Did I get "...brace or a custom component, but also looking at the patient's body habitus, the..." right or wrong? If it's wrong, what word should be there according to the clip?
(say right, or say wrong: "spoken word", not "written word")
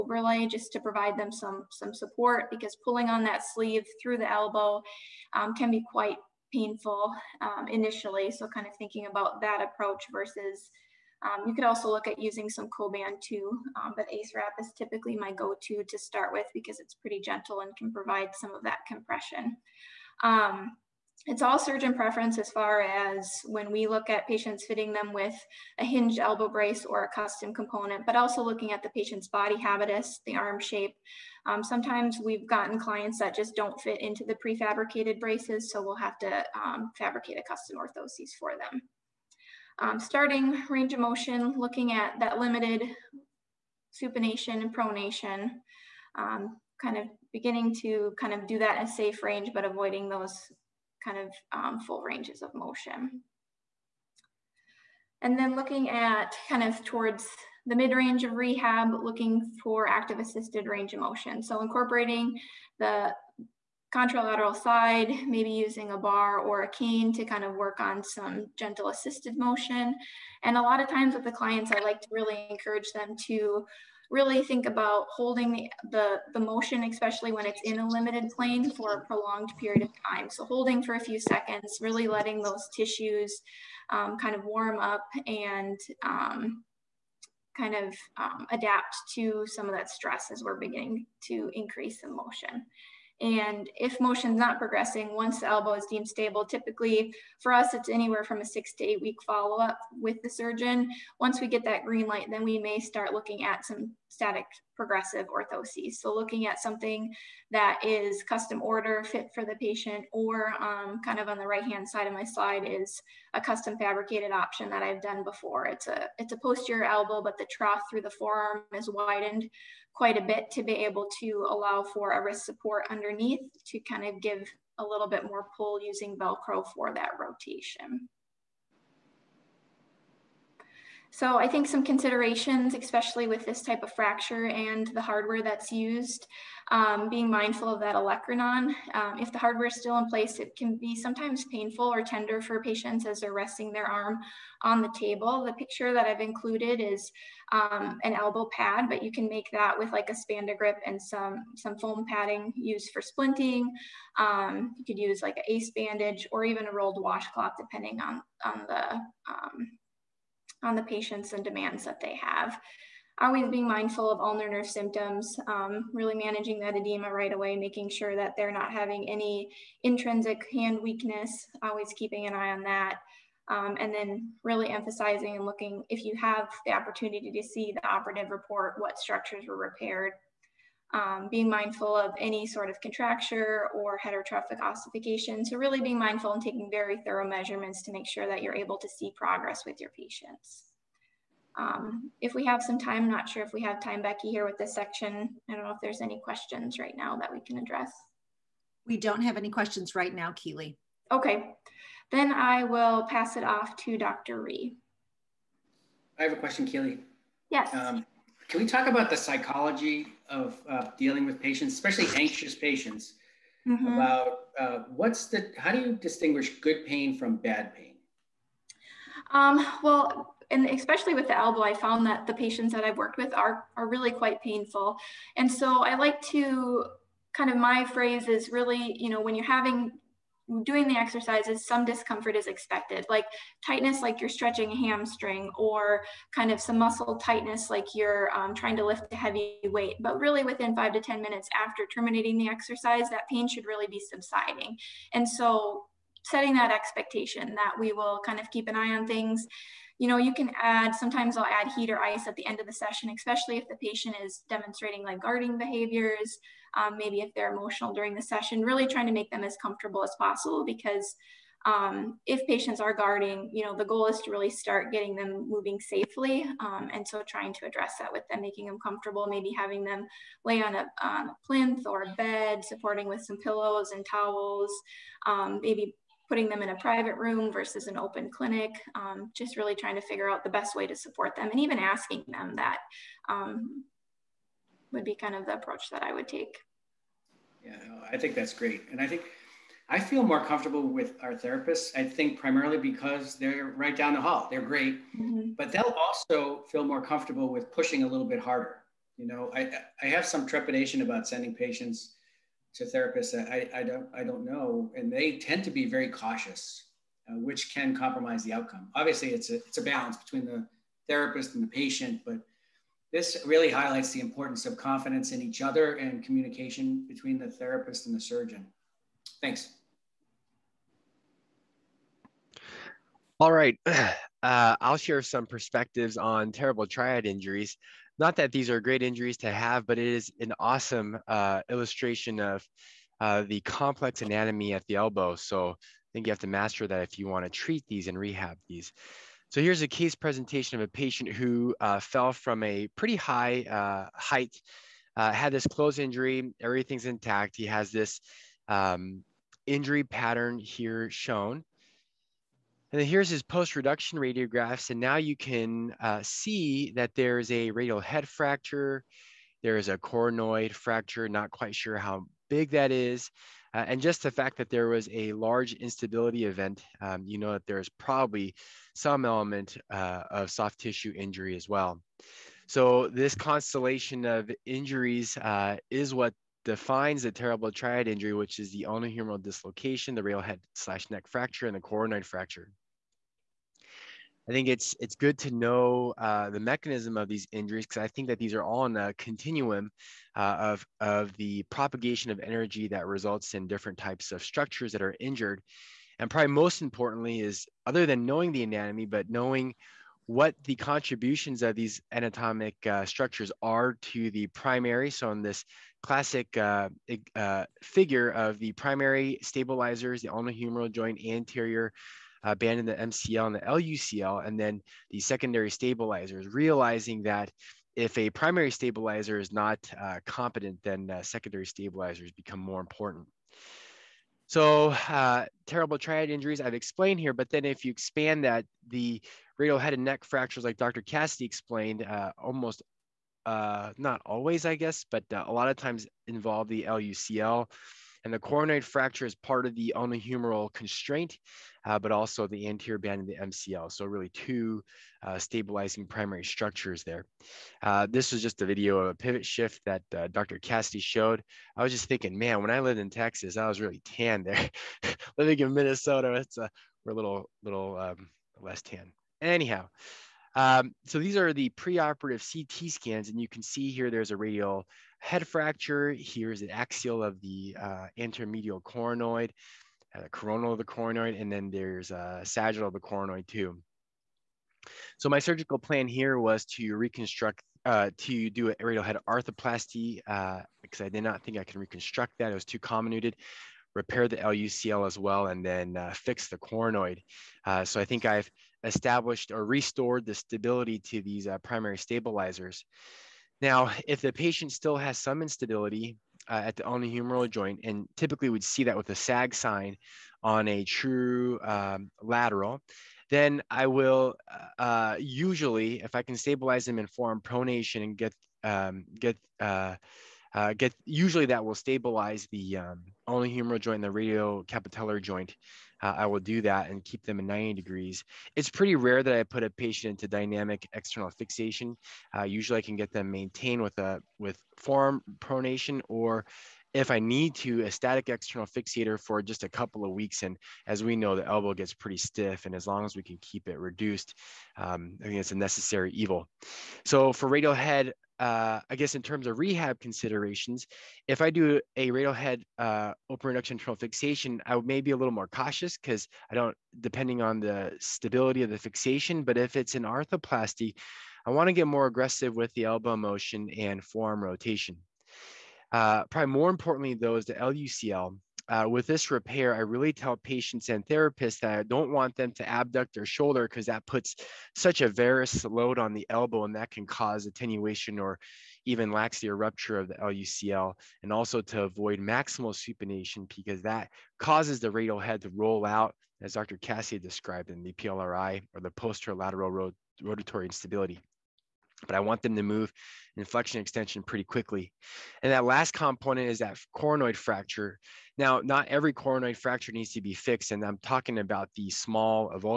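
right.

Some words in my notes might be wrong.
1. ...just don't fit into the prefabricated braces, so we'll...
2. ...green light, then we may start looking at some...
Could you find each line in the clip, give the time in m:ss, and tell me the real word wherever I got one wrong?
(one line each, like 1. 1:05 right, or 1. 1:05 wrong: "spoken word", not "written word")
1. 0:33 right
2. 1:41 right.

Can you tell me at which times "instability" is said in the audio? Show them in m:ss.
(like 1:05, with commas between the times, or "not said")
6:05, 8:15, 9:40.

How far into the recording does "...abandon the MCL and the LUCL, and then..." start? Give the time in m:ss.
6:52.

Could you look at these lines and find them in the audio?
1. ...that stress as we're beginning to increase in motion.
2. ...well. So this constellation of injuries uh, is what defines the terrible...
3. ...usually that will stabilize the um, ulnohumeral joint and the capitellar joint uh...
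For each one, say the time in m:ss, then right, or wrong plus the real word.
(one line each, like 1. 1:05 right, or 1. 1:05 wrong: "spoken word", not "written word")
1. 1:29 right
2. 6:11 right
3. 8:31 right.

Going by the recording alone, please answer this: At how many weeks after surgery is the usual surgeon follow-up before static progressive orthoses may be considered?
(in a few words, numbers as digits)
6 to 8 weeks.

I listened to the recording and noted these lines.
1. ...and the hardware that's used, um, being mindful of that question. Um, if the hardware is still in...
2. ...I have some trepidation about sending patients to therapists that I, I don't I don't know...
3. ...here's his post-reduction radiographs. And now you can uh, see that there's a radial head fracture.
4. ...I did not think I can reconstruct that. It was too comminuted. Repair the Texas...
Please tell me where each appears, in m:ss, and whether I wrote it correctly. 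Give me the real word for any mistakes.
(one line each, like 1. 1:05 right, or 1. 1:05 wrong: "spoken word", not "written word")
1. 2:14 wrong: "olecranon", not "question"
2. 5:00 right
3. 5:53 right
4. 8:01 wrong: "LUCL", not "Texas".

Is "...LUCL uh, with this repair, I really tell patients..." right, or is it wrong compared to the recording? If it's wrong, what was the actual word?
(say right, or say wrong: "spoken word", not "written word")
right.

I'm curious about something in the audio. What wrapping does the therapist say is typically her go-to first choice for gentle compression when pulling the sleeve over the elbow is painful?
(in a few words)
Ace wrap.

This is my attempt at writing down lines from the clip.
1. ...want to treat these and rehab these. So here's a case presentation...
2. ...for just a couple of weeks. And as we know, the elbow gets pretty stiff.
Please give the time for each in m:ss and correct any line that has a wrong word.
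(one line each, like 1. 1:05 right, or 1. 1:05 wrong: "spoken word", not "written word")
1. 5:37 right
2. 8:49 right.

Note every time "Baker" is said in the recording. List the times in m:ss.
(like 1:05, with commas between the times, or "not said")
not said.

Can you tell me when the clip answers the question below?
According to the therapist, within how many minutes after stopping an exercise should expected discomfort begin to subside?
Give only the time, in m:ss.
4:00.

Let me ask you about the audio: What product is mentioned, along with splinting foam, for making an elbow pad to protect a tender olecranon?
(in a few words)
Spandagrip.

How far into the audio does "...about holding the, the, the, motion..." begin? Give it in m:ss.
1:14.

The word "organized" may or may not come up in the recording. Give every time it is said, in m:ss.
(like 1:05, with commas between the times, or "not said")
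not said.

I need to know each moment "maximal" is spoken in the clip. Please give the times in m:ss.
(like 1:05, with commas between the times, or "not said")
9:32.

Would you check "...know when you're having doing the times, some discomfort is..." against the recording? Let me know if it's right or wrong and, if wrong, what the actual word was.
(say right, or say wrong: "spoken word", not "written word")
wrong: "exercises", not "times".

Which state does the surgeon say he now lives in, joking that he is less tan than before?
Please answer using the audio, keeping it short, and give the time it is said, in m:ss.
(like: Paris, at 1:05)
Minnesota, at 7:35.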